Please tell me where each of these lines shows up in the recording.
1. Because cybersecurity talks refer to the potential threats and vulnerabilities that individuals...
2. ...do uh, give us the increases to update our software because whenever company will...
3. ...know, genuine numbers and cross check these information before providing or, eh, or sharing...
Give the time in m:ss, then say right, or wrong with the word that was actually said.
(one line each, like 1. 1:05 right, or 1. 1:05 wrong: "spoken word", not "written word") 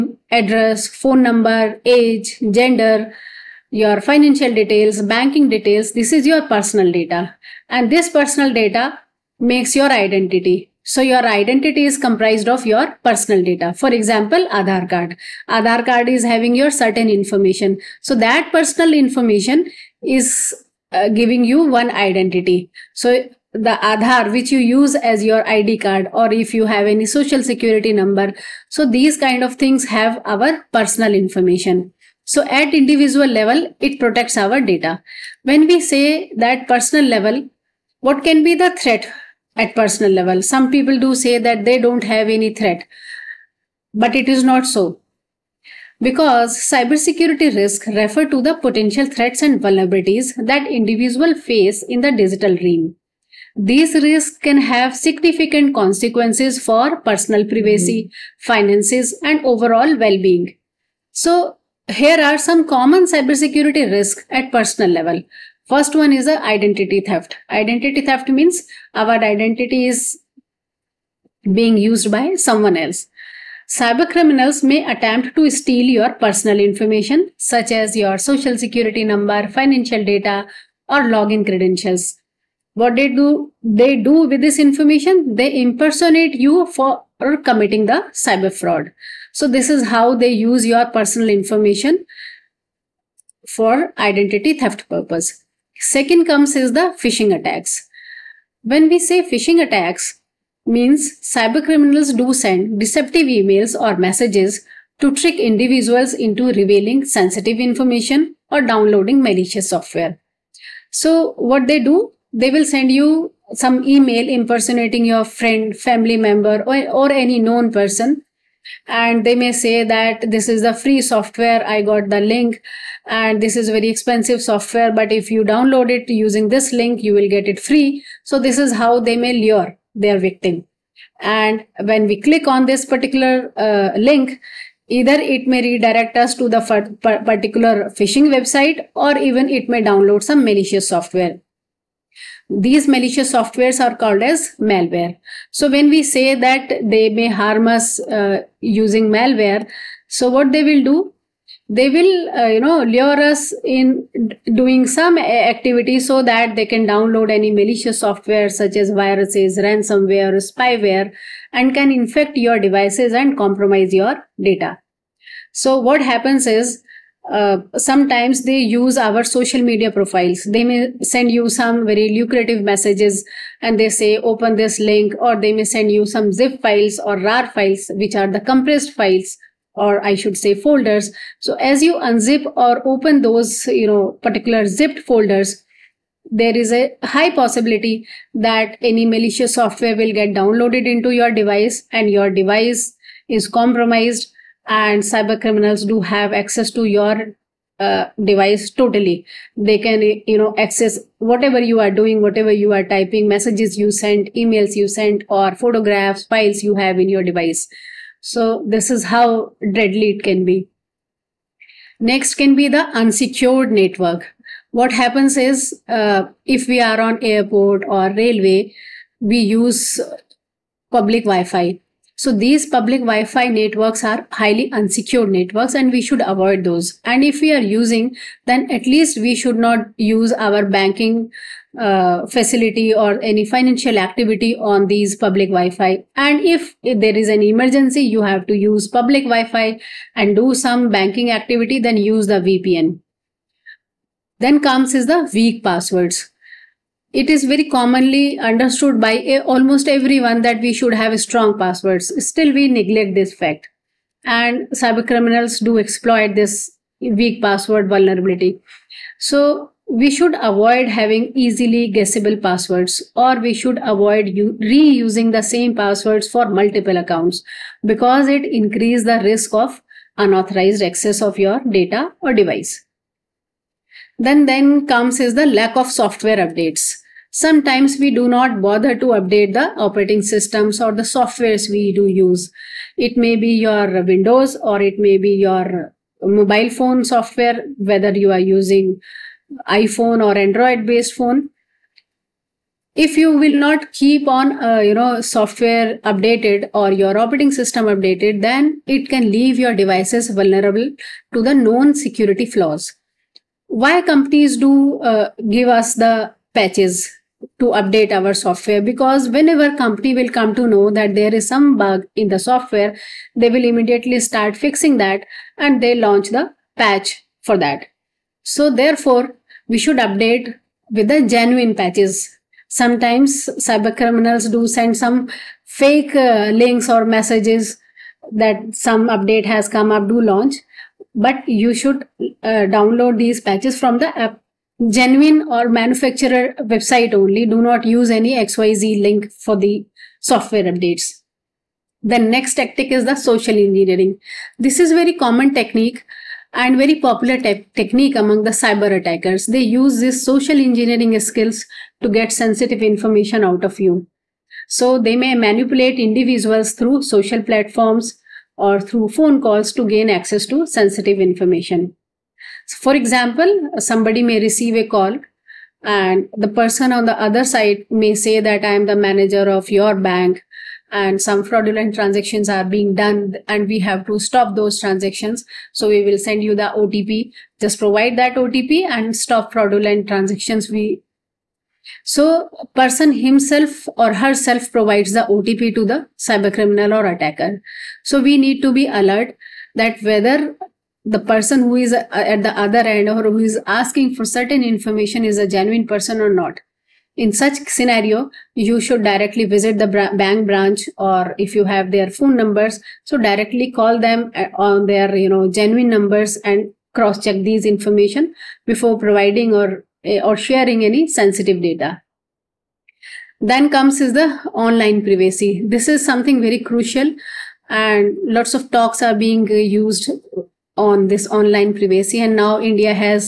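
1. 0:45 wrong: "risks", not "talks"
2. 5:04 wrong: "patches", not "increases"
3. 6:45 right.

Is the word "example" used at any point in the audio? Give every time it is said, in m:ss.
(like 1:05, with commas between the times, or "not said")
0:13, 6:02.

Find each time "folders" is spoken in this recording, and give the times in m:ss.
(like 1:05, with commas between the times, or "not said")
3:00, 3:04.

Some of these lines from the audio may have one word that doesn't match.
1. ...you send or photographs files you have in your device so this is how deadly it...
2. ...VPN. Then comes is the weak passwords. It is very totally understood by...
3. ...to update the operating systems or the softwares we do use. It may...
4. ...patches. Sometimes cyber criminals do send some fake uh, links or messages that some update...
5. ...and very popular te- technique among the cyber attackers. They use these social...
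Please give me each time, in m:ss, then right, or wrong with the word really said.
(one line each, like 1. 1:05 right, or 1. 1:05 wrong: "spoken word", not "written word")
1. 3:24 right
2. 4:02 wrong: "commonly", not "totally"
3. 4:38 right
4. 5:21 right
5. 5:46 right.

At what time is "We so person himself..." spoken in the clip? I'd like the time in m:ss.
6:20.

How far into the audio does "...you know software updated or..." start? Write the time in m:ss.
4:54.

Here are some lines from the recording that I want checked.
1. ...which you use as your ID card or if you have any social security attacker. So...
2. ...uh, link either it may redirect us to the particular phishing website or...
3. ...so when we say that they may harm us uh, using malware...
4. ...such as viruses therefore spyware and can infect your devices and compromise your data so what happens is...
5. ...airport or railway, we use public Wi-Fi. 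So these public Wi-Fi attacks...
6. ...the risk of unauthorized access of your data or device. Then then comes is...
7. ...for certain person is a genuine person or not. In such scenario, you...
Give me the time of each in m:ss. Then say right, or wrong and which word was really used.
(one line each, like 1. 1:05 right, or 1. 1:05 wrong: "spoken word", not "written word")
1. 0:24 wrong: "number", not "attacker"
2. 2:13 right
3. 2:25 right
4. 2:38 wrong: "ransomware", not "therefore"
5. 3:37 wrong: "networks", not "attacks"
6. 4:29 right
7. 6:34 wrong: "information", not "person".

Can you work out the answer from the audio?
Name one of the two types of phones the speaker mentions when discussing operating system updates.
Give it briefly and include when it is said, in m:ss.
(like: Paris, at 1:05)
iPhone, at 4:49.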